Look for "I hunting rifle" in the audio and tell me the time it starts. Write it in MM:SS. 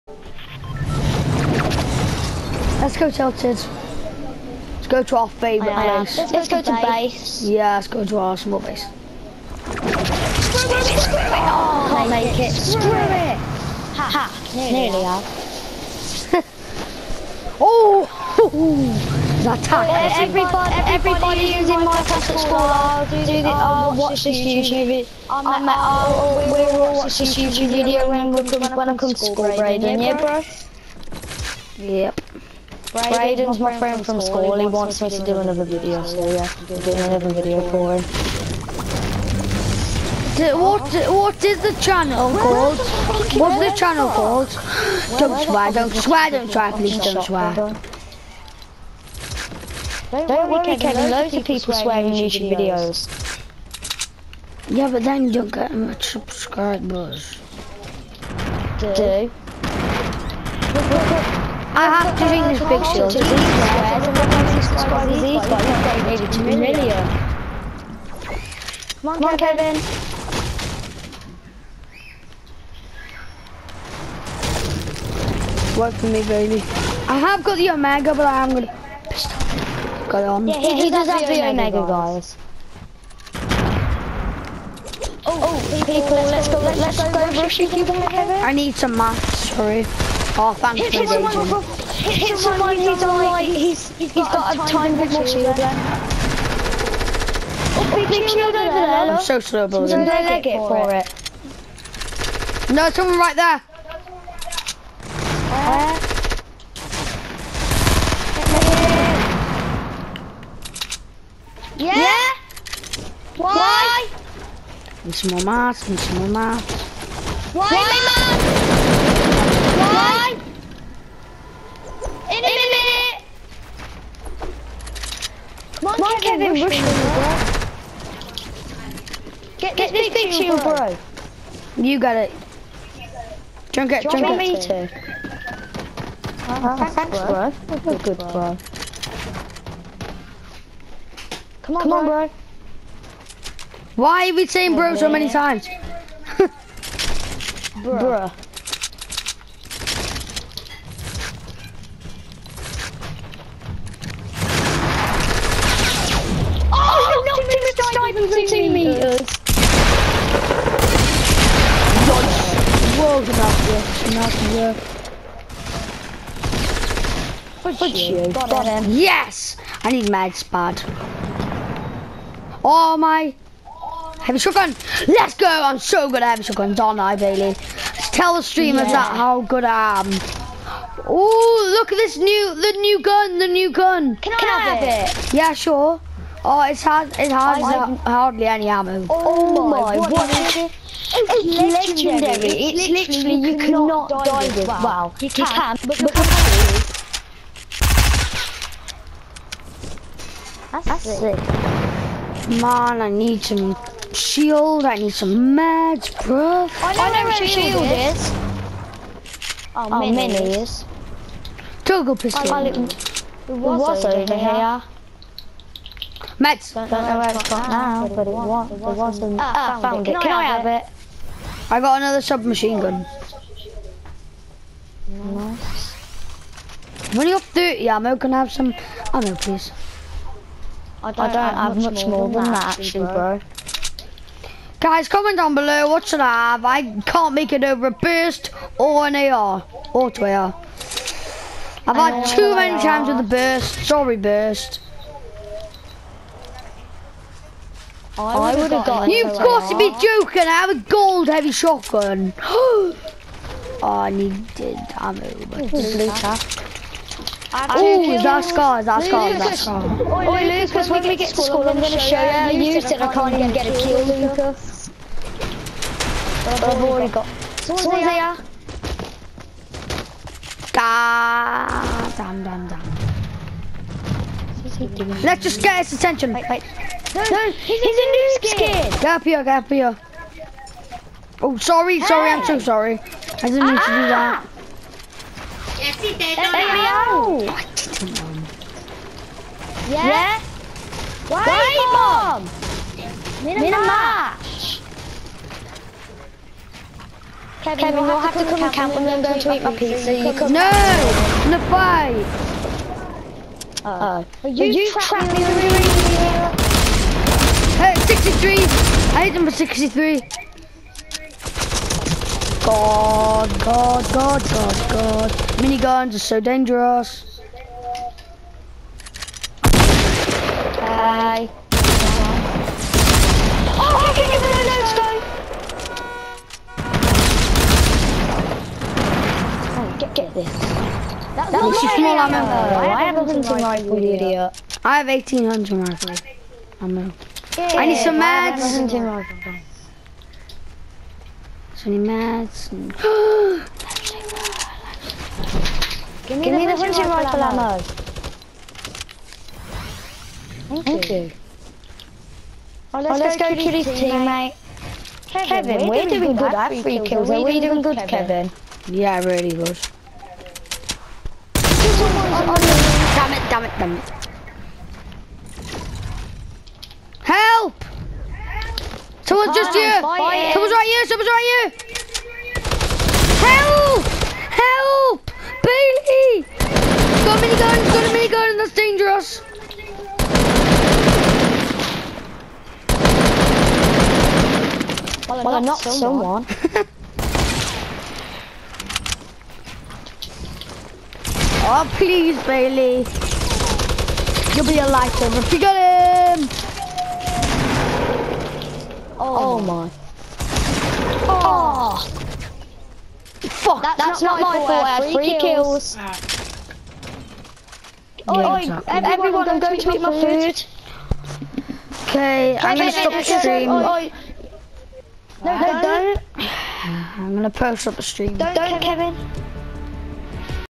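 05:38.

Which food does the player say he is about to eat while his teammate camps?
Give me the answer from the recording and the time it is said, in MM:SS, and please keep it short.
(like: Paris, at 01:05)
pizza, at 04:59.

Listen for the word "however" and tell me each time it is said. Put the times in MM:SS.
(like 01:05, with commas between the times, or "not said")
not said.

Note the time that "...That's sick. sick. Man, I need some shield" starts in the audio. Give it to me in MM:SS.
03:20.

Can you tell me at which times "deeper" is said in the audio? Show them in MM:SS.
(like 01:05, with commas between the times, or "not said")
not said.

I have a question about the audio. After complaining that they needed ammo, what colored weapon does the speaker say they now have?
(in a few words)
gold heavy shotgun.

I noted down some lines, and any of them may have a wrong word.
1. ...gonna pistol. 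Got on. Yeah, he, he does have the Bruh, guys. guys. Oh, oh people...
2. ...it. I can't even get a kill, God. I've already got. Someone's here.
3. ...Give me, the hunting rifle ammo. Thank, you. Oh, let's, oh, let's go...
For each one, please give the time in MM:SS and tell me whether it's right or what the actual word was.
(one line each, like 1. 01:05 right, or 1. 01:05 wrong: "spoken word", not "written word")
1. 01:18 wrong: "Omega", not "Bruh"
2. 04:22 wrong: "Lucas", not "God"
3. 05:46 right.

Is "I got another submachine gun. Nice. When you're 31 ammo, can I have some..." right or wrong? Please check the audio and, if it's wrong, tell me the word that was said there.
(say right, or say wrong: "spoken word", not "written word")
wrong: "30", not "31".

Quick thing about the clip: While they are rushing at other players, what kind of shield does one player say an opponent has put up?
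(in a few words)
time bubble shield.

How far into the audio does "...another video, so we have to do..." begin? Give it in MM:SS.
00:35.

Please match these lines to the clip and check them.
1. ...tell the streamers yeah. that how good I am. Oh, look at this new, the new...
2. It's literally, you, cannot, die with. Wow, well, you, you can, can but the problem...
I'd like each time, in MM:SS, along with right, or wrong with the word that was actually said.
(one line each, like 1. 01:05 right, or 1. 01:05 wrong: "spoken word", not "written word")
1. 02:58 right
2. 03:12 right.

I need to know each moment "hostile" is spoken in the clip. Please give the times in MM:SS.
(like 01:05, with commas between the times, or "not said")
not said.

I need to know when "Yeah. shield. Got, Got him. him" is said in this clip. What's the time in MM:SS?
02:44.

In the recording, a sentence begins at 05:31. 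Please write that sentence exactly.
That was, ammo I have 1,800 rifle, you idiot.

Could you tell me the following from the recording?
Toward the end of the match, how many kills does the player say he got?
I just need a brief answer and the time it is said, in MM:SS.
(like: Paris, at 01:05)
3, at 06:45.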